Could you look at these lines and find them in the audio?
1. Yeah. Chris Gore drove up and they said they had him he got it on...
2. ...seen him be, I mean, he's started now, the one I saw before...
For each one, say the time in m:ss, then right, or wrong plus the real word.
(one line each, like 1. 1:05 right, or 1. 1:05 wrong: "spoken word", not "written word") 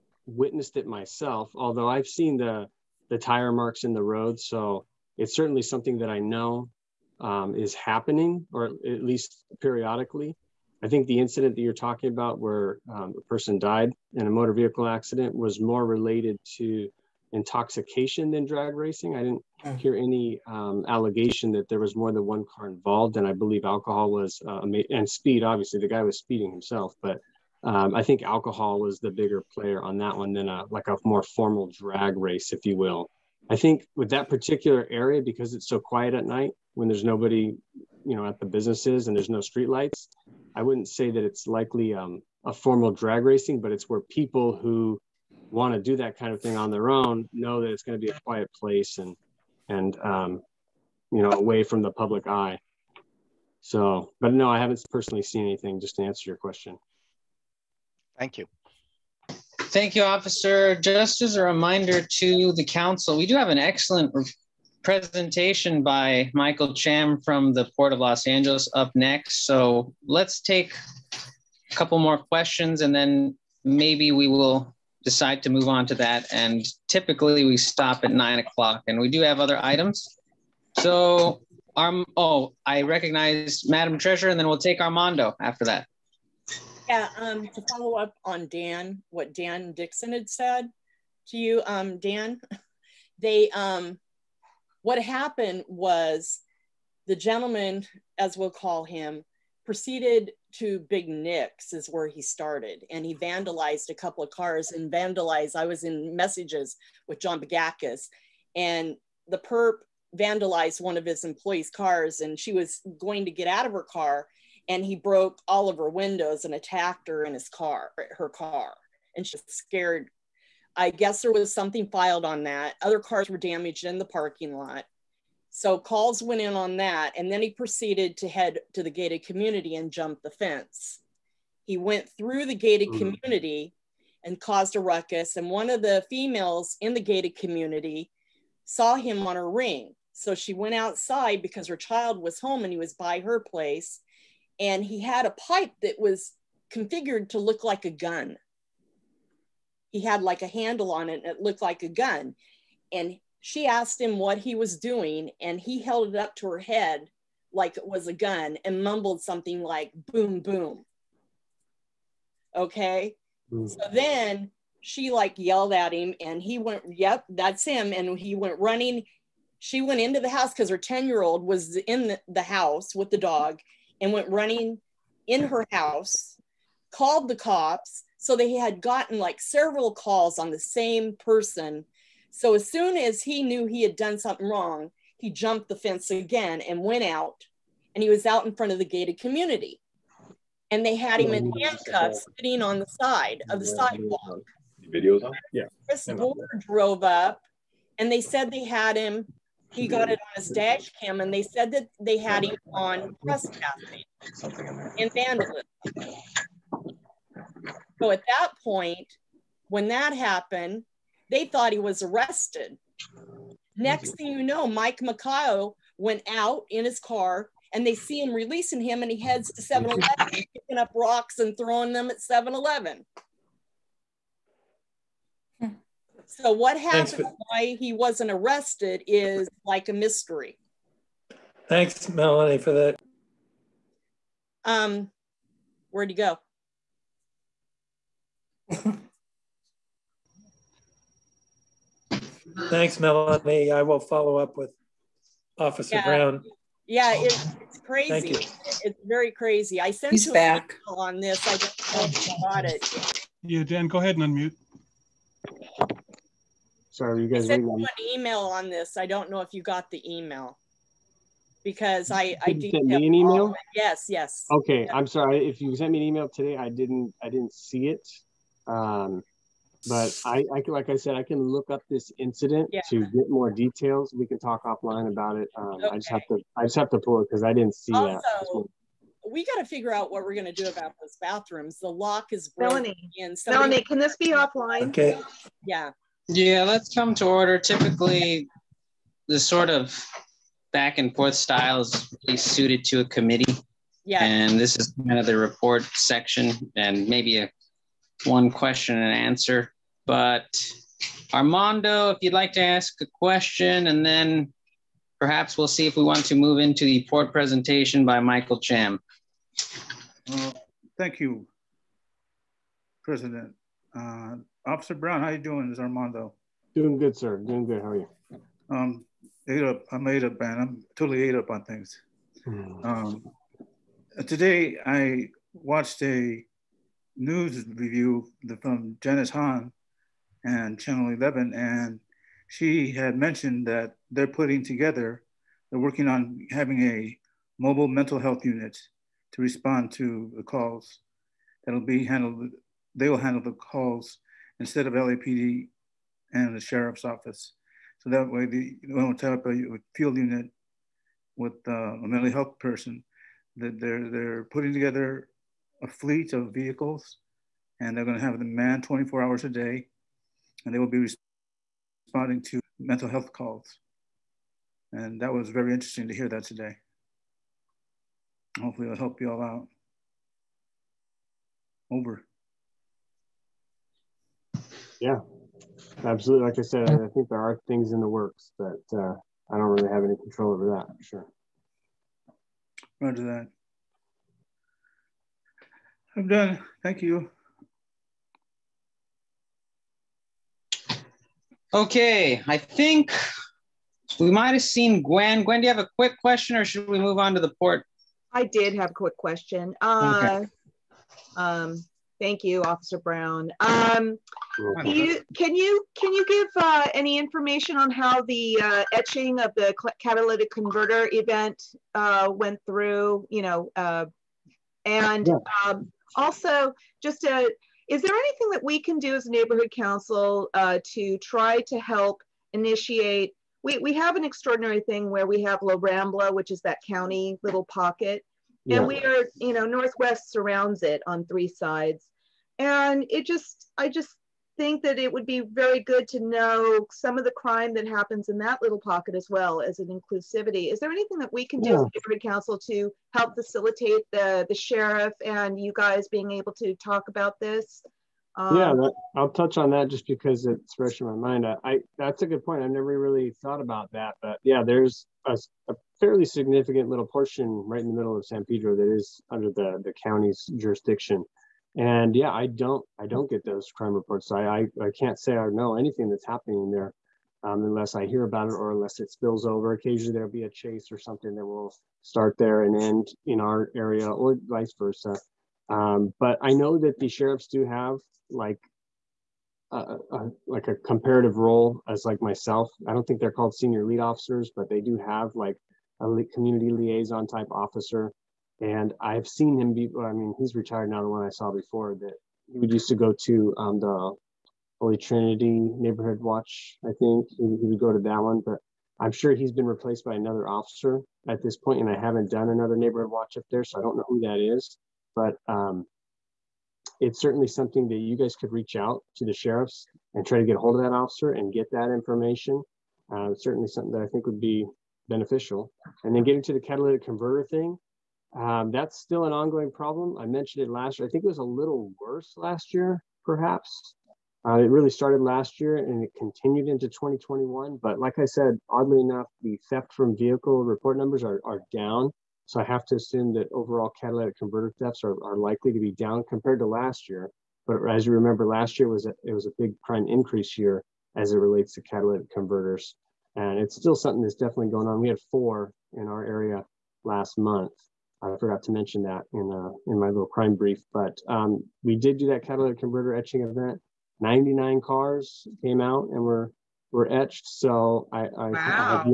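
1. 3:15 right
2. 8:09 wrong: "retired", not "started".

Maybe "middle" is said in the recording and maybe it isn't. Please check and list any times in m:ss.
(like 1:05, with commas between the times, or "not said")
7:37.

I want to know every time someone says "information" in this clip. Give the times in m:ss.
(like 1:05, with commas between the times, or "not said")
6:47, 8:31.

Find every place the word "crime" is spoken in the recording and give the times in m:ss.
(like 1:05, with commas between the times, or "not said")
7:17, 7:43, 9:10.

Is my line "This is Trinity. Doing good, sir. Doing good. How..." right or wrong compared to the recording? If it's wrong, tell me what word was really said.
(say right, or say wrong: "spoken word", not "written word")
wrong: "Armando", not "Trinity".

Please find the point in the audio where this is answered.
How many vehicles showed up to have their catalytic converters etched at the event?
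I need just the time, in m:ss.
9:14.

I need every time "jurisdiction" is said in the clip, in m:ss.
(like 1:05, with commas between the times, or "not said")
7:40.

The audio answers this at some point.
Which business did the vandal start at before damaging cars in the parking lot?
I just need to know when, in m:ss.
1:40.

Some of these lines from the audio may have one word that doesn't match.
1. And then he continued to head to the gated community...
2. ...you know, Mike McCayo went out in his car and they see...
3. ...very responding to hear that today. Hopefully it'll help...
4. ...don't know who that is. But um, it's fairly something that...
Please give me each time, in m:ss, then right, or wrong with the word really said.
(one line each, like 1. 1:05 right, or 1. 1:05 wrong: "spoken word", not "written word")
1. 2:07 wrong: "proceeded", not "continued"
2. 3:34 right
3. 6:05 wrong: "interesting", not "responding"
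4. 8:23 wrong: "certainly", not "fairly".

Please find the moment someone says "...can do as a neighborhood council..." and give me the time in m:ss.
6:58.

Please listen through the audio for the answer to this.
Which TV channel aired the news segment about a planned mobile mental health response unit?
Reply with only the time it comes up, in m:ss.
5:30.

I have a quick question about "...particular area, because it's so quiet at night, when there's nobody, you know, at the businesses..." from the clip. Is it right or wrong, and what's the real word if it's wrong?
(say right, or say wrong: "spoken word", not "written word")
right.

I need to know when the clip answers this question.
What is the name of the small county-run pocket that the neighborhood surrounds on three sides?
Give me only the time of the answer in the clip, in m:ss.
7:05.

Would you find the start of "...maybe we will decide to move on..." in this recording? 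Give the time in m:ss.
1:13.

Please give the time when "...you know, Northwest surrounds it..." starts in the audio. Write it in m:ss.
7:09.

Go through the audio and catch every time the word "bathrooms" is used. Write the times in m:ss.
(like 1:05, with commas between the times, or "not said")
4:41.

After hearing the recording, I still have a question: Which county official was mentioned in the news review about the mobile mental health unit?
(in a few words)
Janice Hahn.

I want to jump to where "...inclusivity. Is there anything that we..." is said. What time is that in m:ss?
7:19.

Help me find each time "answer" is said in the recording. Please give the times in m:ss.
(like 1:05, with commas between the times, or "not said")
0:56, 4:59.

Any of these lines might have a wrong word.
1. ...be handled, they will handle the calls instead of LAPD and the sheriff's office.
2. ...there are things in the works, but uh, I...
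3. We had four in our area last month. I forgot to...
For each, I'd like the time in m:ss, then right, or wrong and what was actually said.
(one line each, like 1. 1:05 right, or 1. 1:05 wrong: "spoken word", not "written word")
1. 5:41 right
2. 6:17 right
3. 9:04 right.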